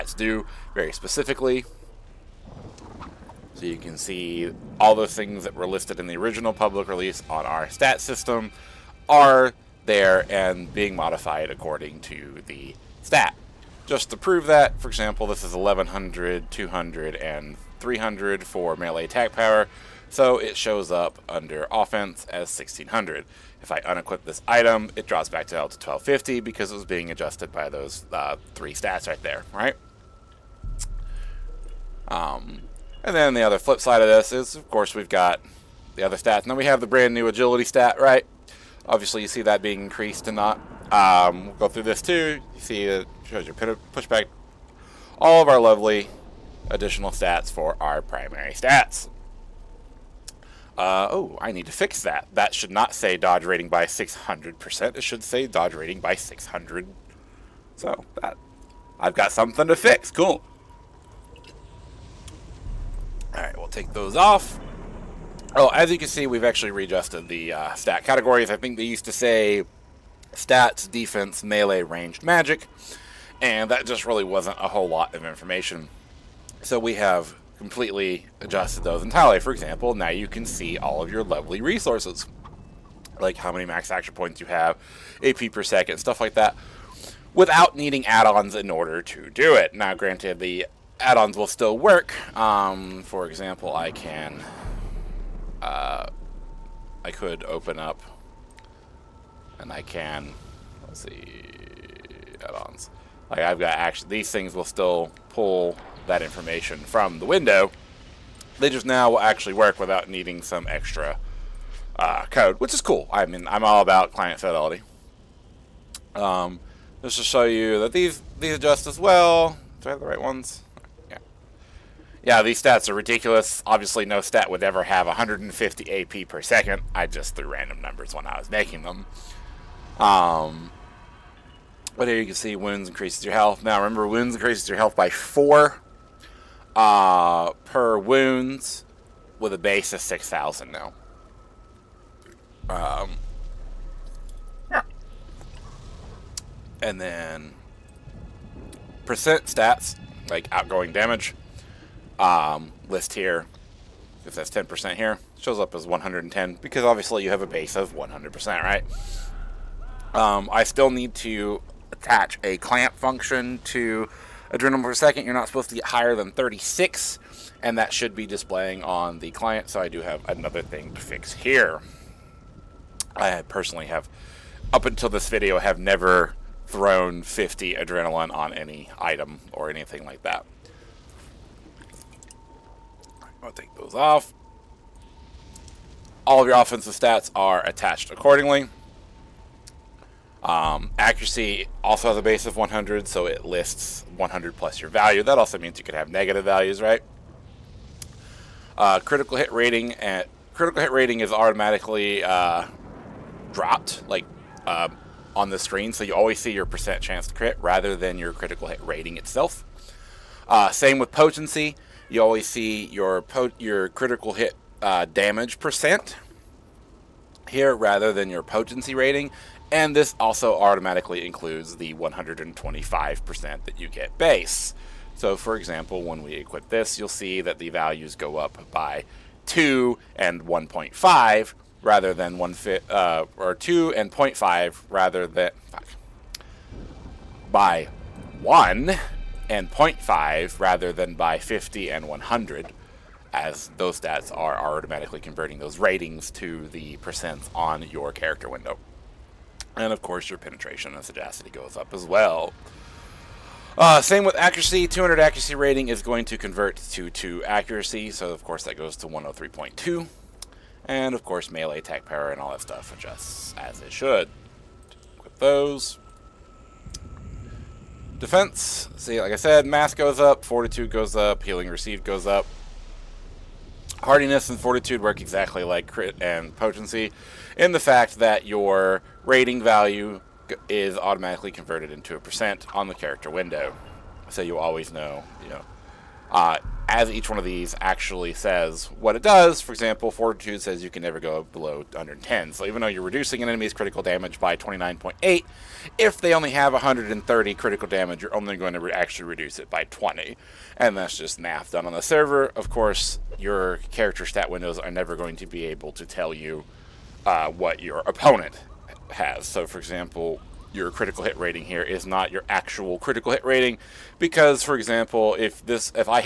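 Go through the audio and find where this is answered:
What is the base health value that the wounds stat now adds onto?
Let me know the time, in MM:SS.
02:20.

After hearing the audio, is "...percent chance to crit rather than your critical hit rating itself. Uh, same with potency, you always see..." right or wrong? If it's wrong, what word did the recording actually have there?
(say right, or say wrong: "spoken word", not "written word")
right.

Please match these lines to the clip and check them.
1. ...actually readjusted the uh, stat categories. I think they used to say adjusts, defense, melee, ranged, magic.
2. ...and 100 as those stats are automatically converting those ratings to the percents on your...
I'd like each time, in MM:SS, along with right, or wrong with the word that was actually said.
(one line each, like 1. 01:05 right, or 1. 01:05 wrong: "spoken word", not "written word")
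1. 01:06 wrong: "stats", not "adjusts"
2. 04:01 right.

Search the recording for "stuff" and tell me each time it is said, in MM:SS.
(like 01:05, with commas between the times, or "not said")
01:25, 04:22.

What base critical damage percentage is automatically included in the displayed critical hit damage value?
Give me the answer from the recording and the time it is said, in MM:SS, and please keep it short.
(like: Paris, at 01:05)
125%, at 03:41.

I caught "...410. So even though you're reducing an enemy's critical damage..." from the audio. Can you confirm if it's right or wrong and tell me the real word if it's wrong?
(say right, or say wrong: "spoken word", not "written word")
wrong: "110", not "410".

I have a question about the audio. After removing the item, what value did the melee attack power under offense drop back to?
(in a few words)
1250.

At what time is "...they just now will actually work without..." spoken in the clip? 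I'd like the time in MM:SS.
01:48.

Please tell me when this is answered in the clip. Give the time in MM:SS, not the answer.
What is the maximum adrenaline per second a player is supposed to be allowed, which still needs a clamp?
02:46.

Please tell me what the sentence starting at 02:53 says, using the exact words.
I personally have, up until this video, have never thrown 50 adrenaline on any item or anything like that.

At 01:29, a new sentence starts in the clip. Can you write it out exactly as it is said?
Now, granted, the add-ons will still work.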